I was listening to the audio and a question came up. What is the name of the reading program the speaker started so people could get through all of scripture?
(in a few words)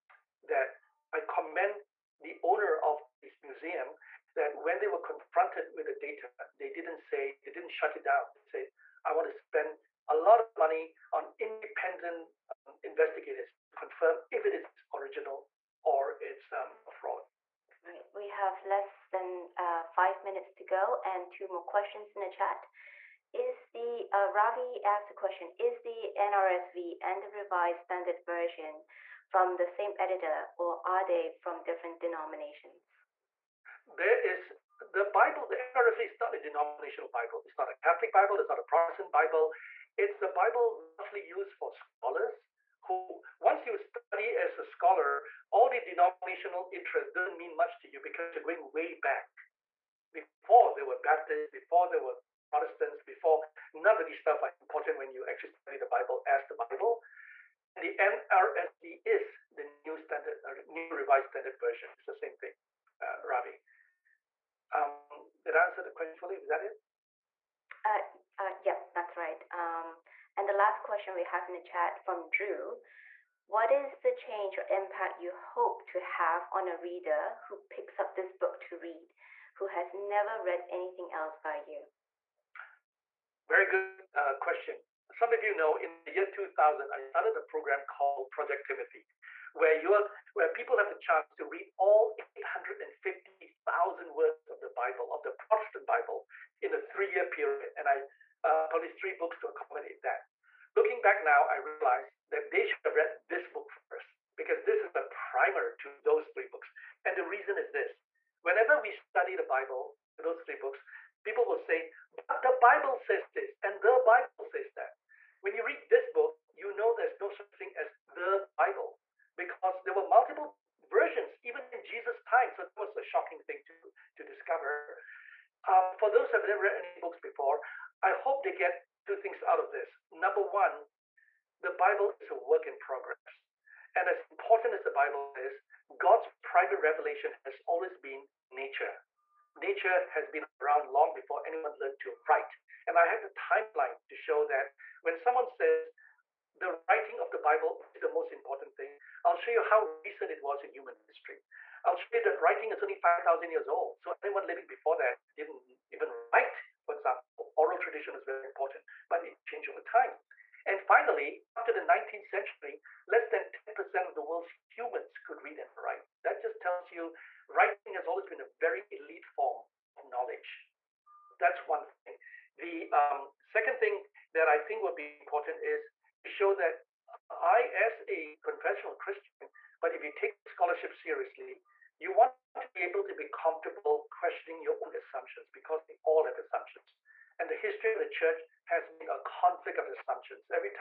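Project Timothy.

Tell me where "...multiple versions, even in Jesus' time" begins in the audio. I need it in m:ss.
2:00.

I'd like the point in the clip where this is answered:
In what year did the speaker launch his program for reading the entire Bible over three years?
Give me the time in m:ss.
1:26.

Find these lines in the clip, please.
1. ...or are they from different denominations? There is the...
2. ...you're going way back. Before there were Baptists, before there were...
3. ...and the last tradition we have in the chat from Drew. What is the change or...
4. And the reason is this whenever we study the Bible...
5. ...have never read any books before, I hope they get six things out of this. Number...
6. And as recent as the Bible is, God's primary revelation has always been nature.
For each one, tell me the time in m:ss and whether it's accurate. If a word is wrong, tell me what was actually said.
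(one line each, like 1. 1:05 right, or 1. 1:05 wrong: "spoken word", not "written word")
1. 0:30 right
2. 0:48 right
3. 1:10 wrong: "question", not "tradition"
4. 1:47 right
5. 2:06 wrong: "two", not "six"
6. 2:13 wrong: "important", not "recent".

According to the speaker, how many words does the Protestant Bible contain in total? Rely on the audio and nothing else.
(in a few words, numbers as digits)
850,000.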